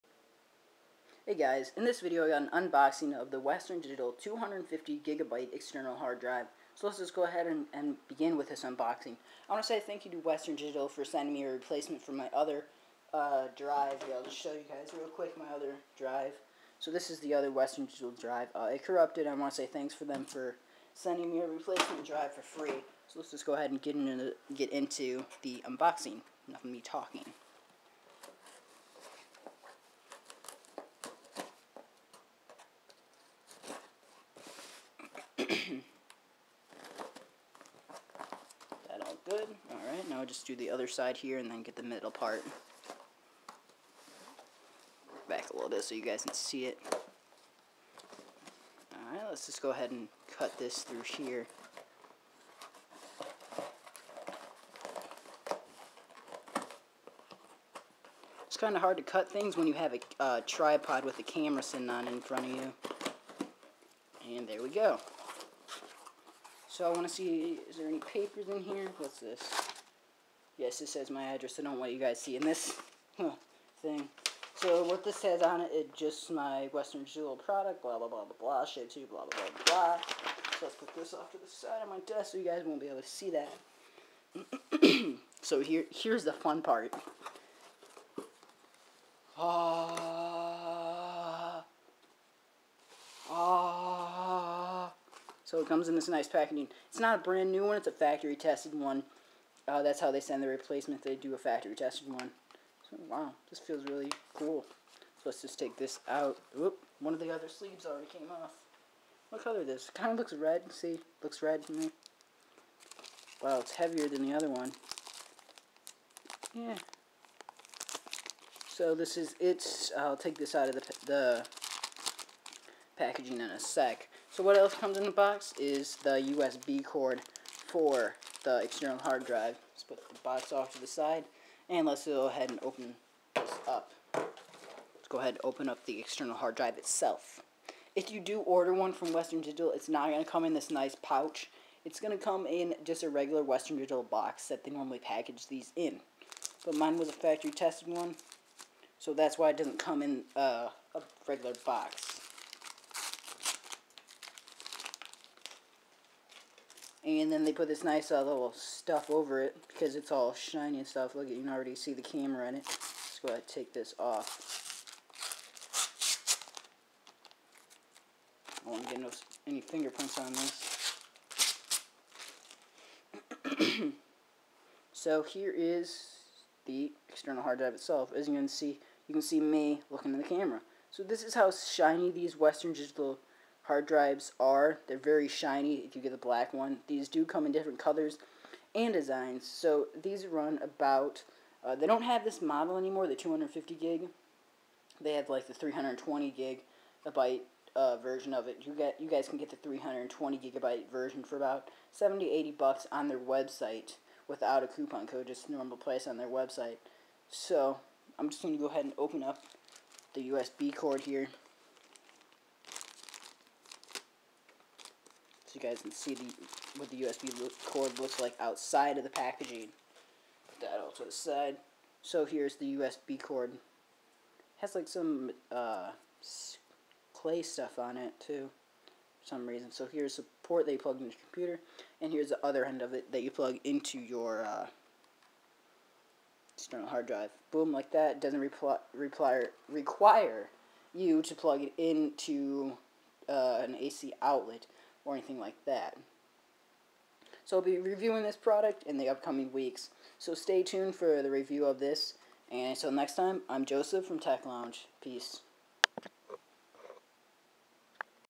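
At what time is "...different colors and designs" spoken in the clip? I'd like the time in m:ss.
3:07.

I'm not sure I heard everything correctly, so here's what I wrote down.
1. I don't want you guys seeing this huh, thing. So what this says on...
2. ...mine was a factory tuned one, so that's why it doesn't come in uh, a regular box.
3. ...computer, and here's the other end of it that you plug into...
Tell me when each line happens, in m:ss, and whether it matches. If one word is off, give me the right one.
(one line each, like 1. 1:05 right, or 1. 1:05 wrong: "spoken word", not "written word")
1. 1:11 right
2. 2:26 wrong: "tested", not "tuned"
3. 3:51 right.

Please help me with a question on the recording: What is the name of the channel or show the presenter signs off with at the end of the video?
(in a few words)
Tech Lounge.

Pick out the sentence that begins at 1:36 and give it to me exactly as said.
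It's not a brand new one, it's a factory tested one.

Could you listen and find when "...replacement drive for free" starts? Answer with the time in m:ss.
0:21.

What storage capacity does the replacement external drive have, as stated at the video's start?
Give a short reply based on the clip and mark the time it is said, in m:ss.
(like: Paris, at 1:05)
250 gigabyte, at 0:04.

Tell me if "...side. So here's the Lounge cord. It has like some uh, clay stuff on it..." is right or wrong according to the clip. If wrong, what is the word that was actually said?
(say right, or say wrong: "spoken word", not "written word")
wrong: "USB", not "Lounge".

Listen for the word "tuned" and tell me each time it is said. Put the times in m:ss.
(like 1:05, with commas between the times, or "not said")
4:10.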